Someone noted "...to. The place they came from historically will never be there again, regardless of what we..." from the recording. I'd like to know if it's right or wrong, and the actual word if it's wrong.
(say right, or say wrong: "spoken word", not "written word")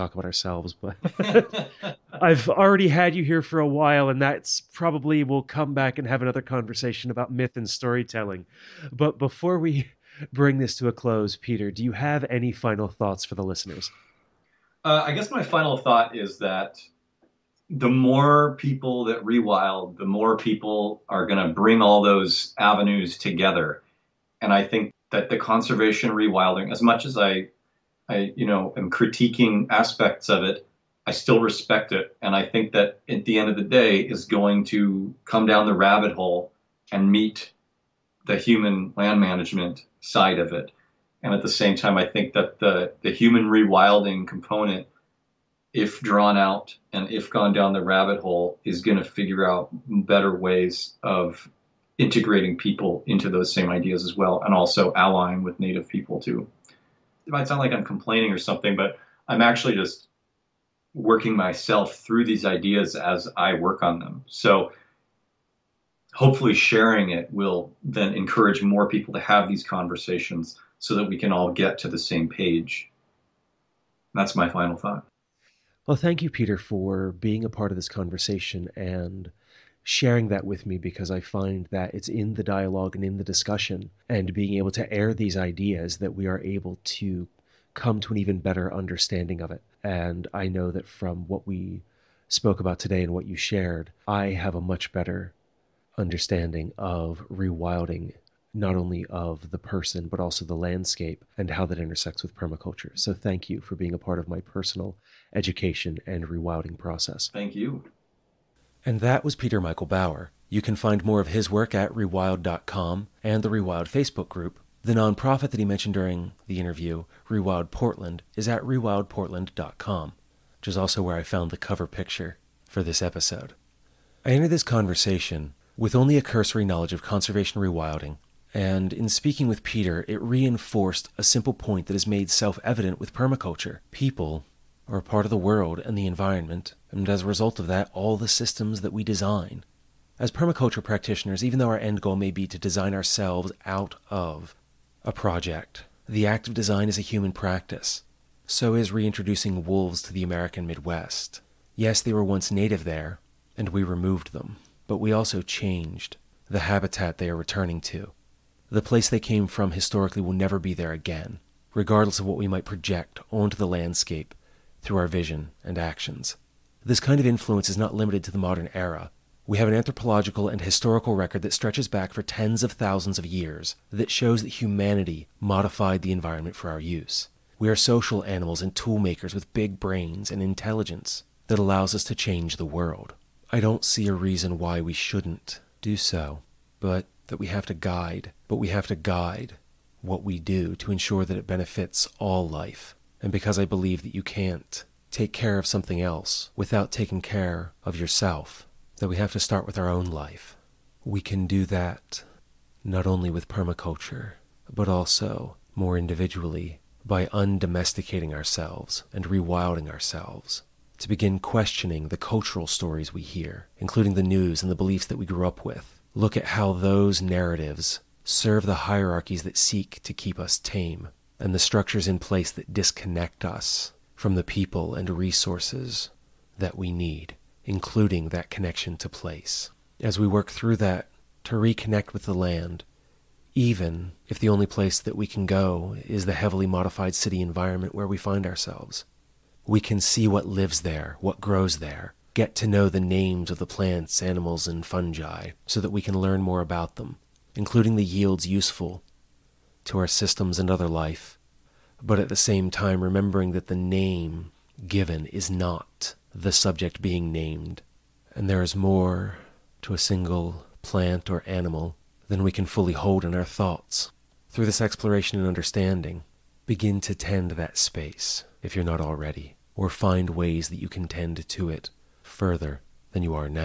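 right.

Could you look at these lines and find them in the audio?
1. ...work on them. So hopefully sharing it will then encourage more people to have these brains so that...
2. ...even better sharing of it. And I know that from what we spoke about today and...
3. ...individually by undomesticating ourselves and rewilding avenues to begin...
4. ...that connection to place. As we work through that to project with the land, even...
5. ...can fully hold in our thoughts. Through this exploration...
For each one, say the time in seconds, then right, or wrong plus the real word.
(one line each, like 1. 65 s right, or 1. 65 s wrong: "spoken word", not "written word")
1. 63 s wrong: "conversations", not "brains"
2. 88 s wrong: "understanding", not "sharing"
3. 205 s wrong: "ourselves", not "avenues"
4. 228 s wrong: "reconnect", not "project"
5. 262 s right.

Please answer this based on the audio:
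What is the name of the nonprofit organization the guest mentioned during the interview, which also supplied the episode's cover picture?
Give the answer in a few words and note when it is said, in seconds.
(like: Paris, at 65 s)
Rewild Portland, at 117 s.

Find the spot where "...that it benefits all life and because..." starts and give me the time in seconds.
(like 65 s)
191 s.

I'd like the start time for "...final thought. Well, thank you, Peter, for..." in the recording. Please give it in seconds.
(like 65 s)
74 s.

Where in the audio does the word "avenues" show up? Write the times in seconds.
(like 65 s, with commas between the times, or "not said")
22 s.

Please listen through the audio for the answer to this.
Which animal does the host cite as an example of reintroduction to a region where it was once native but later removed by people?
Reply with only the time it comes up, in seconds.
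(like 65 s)
149 s.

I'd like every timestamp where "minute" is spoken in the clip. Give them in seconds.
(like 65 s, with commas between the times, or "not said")
not said.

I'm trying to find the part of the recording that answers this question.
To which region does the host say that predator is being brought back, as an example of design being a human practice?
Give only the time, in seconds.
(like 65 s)
150 s.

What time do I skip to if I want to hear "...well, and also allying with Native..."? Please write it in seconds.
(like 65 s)
54 s.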